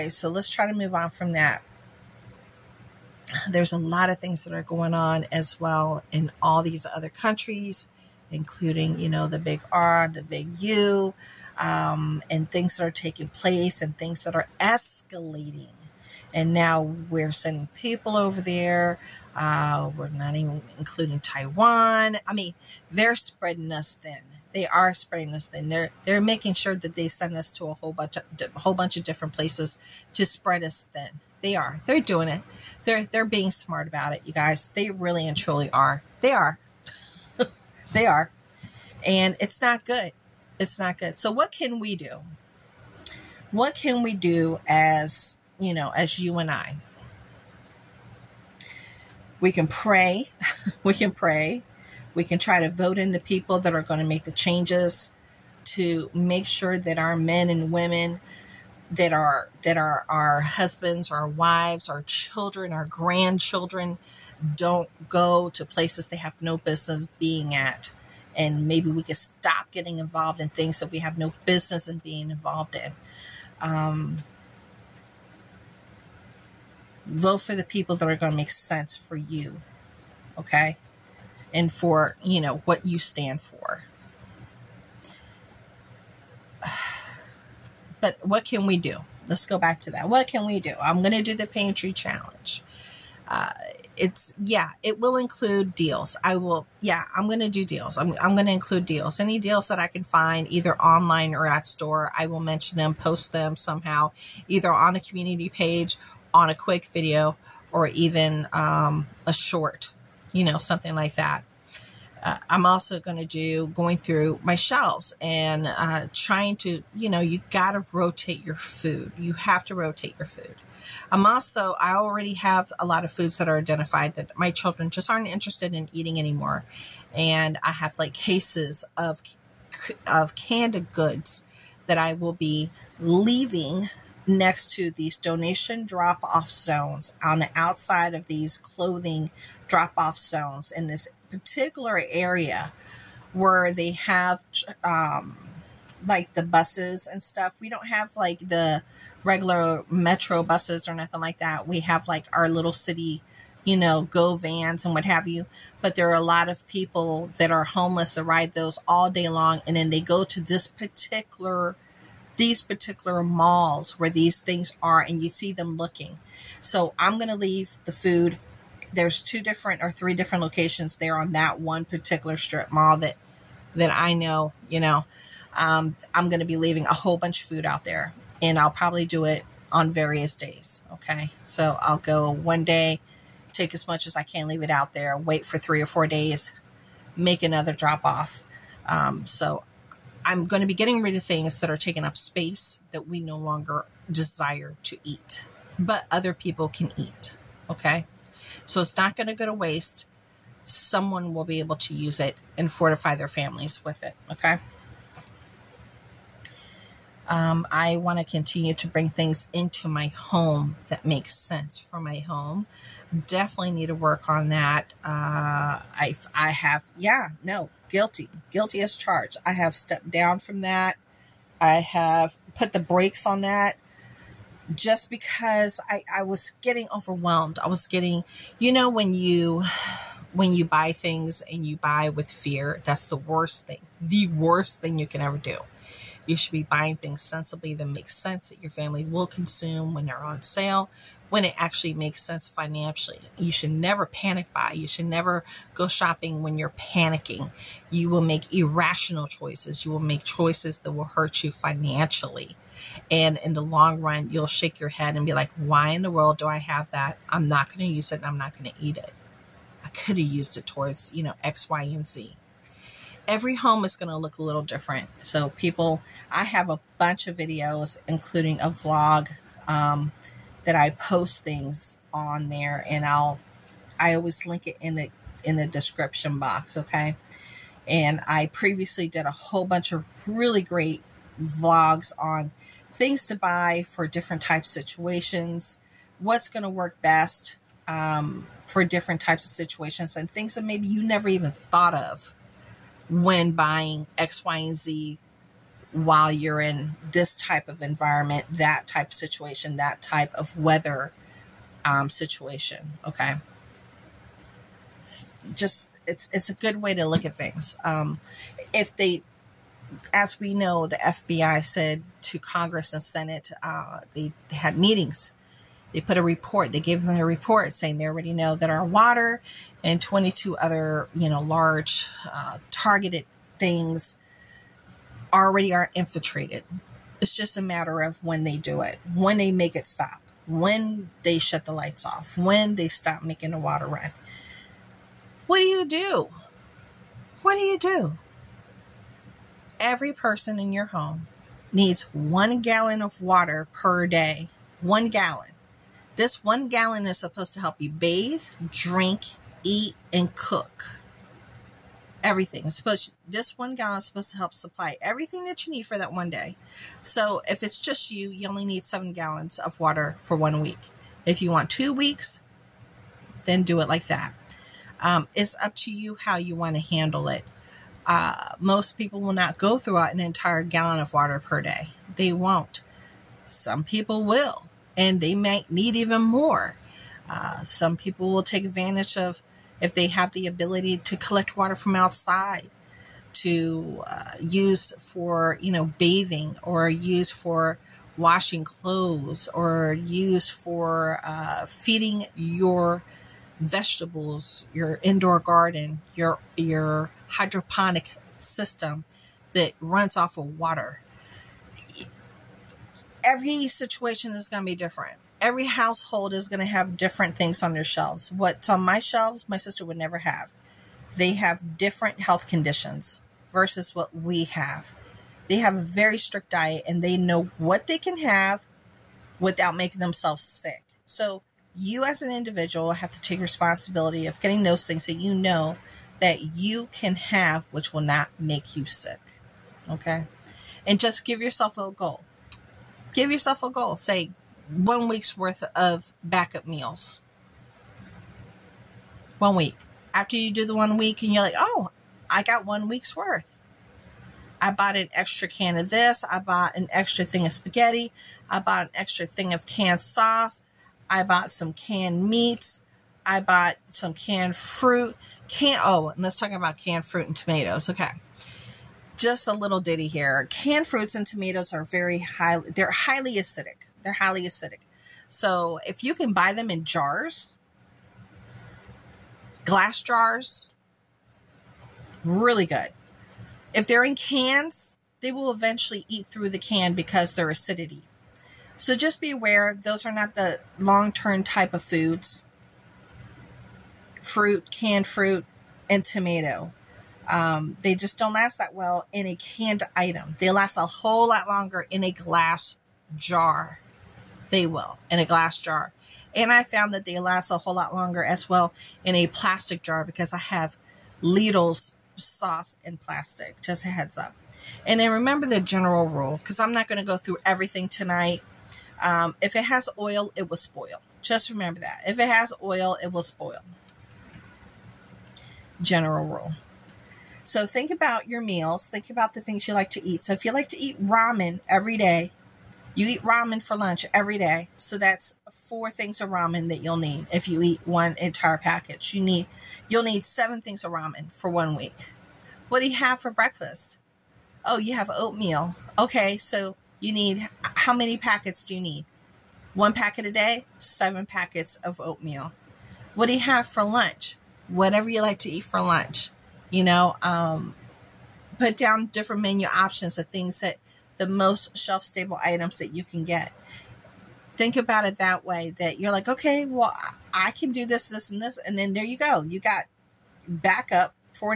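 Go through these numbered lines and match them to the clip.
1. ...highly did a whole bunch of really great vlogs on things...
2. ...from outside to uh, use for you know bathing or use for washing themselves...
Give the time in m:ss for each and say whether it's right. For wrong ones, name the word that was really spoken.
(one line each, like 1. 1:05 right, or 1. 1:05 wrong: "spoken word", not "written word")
1. 4:38 wrong: "previously", not "highly"
2. 6:21 wrong: "clothes", not "themselves".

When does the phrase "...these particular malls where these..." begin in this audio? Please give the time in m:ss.
2:42.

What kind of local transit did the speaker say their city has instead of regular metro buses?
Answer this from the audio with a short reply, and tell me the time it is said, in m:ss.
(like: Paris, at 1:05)
go vans, at 2:34.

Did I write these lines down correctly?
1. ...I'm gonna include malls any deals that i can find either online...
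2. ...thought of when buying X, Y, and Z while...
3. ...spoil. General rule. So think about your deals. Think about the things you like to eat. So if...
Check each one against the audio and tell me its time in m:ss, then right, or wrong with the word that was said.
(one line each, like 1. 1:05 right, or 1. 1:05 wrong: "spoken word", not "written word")
1. 1:38 wrong: "deals", not "malls"
2. 4:51 right
3. 8:33 wrong: "meals", not "deals".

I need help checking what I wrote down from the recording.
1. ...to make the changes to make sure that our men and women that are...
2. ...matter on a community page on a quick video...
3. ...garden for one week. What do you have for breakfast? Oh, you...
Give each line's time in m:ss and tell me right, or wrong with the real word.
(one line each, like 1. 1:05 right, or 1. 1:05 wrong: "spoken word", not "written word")
1. 0:53 right
2. 1:44 wrong: "either", not "matter"
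3. 8:50 wrong: "ramen", not "garden".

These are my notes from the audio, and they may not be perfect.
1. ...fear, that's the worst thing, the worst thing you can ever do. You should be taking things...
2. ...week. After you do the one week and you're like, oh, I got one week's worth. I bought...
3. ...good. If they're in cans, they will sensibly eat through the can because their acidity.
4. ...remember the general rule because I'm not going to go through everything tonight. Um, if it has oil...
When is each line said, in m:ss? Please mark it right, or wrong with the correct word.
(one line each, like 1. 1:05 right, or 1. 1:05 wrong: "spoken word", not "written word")
1. 3:52 wrong: "buying", not "taking"
2. 7:19 right
3. 7:52 wrong: "eventually", not "sensibly"
4. 8:25 right.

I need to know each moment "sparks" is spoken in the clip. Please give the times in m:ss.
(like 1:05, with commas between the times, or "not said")
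not said.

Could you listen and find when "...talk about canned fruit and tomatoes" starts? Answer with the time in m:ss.
7:36.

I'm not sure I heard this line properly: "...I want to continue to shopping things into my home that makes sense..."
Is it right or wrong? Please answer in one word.
wrong.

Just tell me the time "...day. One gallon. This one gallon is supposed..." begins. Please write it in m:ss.
5:44.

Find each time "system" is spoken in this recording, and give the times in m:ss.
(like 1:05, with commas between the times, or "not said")
6:38.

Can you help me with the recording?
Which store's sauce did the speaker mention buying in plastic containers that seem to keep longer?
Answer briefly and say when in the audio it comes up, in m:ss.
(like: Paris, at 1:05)
Lidl, at 8:21.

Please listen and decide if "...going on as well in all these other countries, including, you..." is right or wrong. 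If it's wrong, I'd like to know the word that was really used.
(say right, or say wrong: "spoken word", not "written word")
right.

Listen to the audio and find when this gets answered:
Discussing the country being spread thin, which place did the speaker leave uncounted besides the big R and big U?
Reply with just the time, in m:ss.
0:21.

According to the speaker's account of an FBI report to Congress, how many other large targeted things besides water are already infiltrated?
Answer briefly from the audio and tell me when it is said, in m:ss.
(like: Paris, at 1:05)
22, at 5:20.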